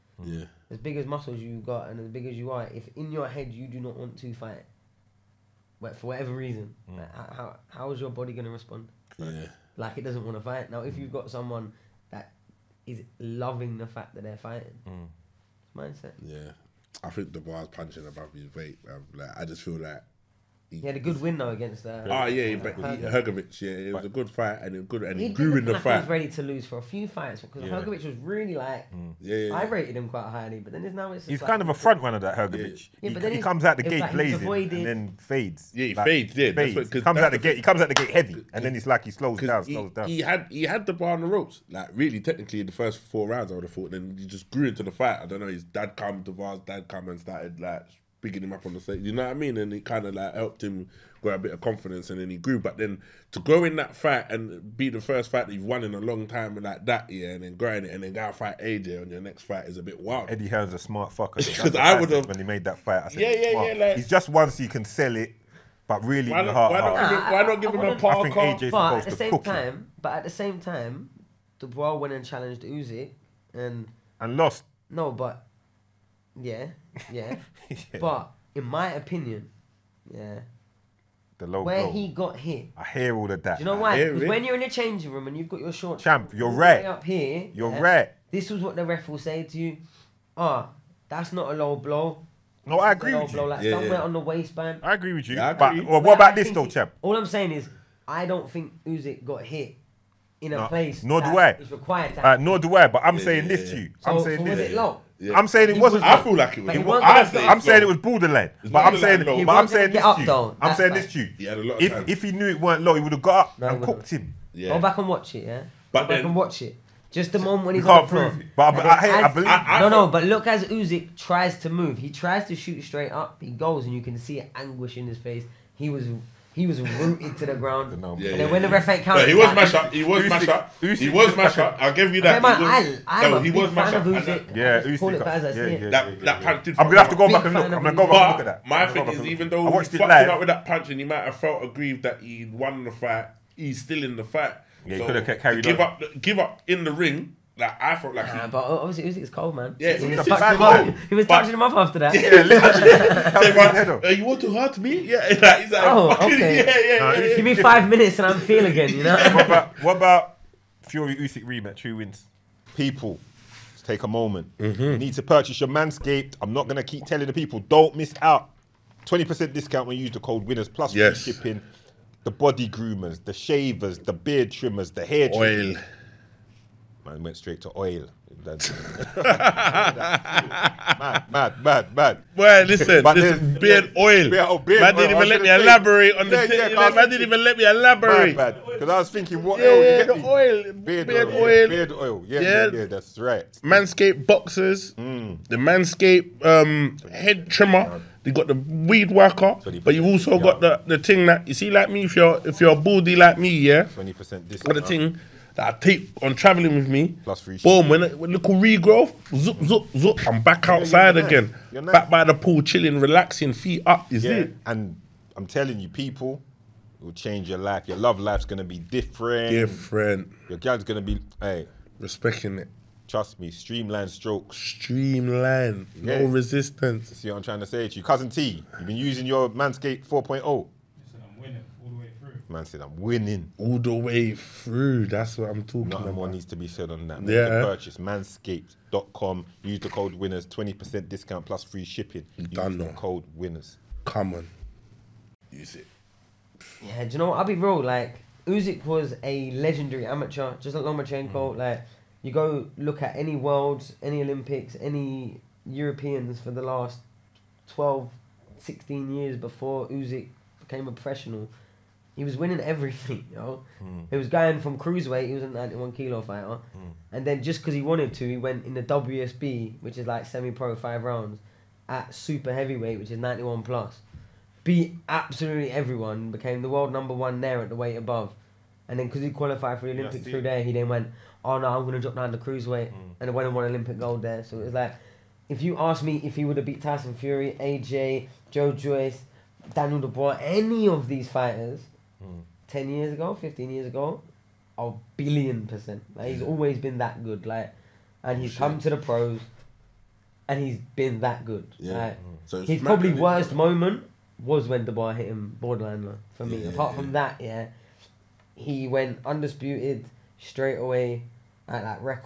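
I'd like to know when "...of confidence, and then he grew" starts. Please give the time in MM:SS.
00:51.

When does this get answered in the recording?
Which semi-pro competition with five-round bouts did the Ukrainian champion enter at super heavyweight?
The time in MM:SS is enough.
04:28.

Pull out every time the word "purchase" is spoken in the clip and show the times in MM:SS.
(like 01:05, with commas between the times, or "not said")
02:45, 03:57.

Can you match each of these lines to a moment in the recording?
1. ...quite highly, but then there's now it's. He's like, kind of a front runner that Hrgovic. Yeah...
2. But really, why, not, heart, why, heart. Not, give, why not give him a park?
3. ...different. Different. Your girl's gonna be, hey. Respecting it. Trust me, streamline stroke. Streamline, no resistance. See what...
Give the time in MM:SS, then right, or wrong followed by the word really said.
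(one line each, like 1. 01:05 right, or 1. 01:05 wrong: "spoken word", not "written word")
1. 00:30 right
2. 01:05 right
3. 03:38 right.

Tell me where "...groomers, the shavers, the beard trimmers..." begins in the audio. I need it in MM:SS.
02:52.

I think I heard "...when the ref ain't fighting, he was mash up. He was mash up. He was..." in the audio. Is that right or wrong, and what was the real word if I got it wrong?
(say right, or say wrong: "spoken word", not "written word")
wrong: "counting", not "fighting".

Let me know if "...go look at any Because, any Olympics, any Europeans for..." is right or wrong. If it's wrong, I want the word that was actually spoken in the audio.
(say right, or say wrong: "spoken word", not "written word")
wrong: "Worlds", not "Because".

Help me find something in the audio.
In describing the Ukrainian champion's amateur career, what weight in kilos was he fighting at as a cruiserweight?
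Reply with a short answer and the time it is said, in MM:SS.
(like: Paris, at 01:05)
91 kilo, at 04:25.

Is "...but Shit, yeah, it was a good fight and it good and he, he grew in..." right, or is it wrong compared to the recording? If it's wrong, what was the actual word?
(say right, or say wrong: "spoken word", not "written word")
wrong: "Hrgovic", not "Shit".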